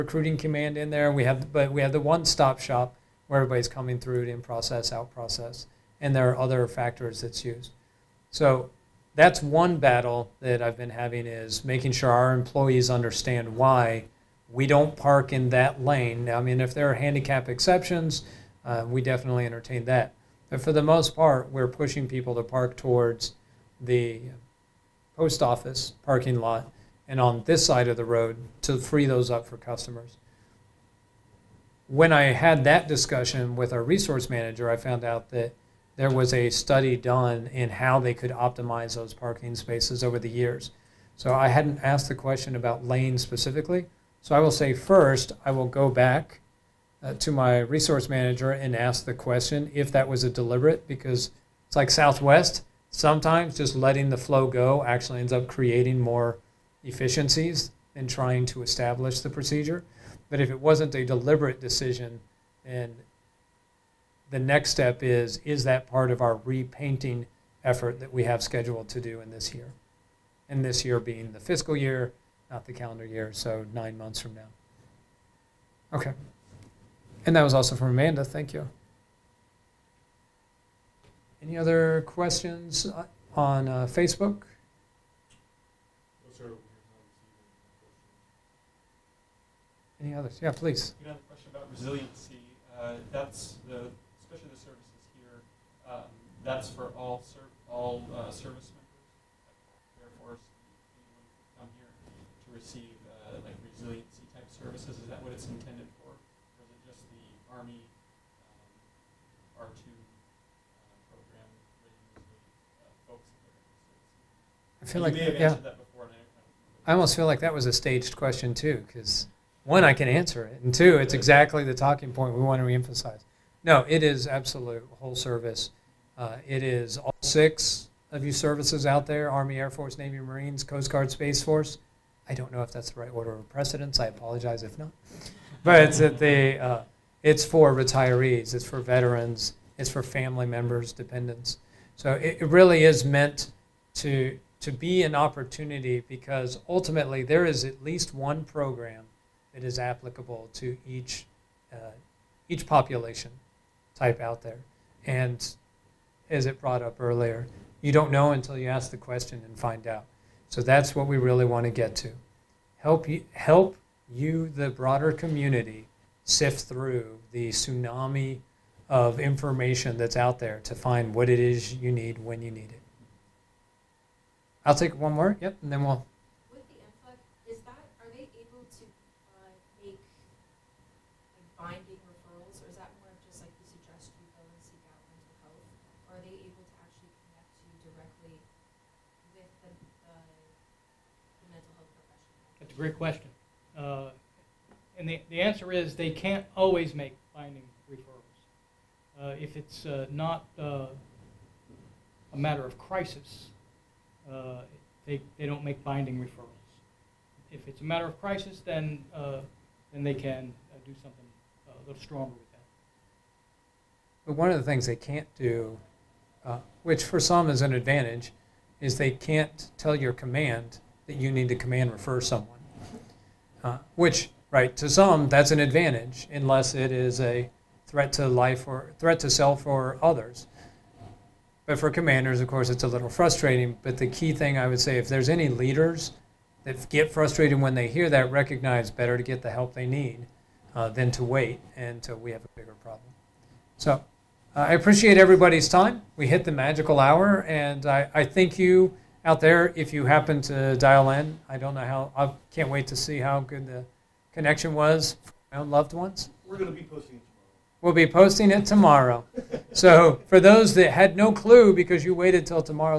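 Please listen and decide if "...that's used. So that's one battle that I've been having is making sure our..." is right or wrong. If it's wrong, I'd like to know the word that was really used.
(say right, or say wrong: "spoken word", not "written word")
right.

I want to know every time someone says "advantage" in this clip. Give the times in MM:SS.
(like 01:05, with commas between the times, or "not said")
03:37, 03:45.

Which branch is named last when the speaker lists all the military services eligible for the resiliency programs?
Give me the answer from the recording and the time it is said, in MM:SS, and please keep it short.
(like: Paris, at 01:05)
Space Force, at 02:11.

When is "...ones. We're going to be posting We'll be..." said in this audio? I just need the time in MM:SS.
04:15.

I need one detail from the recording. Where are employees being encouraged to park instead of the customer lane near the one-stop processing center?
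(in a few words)
Post office parking lot.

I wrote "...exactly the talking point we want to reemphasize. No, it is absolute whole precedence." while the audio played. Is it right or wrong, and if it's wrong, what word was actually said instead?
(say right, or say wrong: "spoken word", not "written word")
wrong: "service", not "precedence".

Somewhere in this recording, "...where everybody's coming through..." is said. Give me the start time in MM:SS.
00:03.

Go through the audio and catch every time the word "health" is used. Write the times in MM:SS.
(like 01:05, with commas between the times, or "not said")
03:05, 03:11.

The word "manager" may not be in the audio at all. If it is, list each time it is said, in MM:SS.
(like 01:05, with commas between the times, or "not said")
00:34, 00:48.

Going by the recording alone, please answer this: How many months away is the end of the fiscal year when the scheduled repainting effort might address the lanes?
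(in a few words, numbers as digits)
9.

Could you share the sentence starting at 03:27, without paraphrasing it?
If it's a matter of crisis, then, uh, then they can uh, do something uh, a little stronger with that.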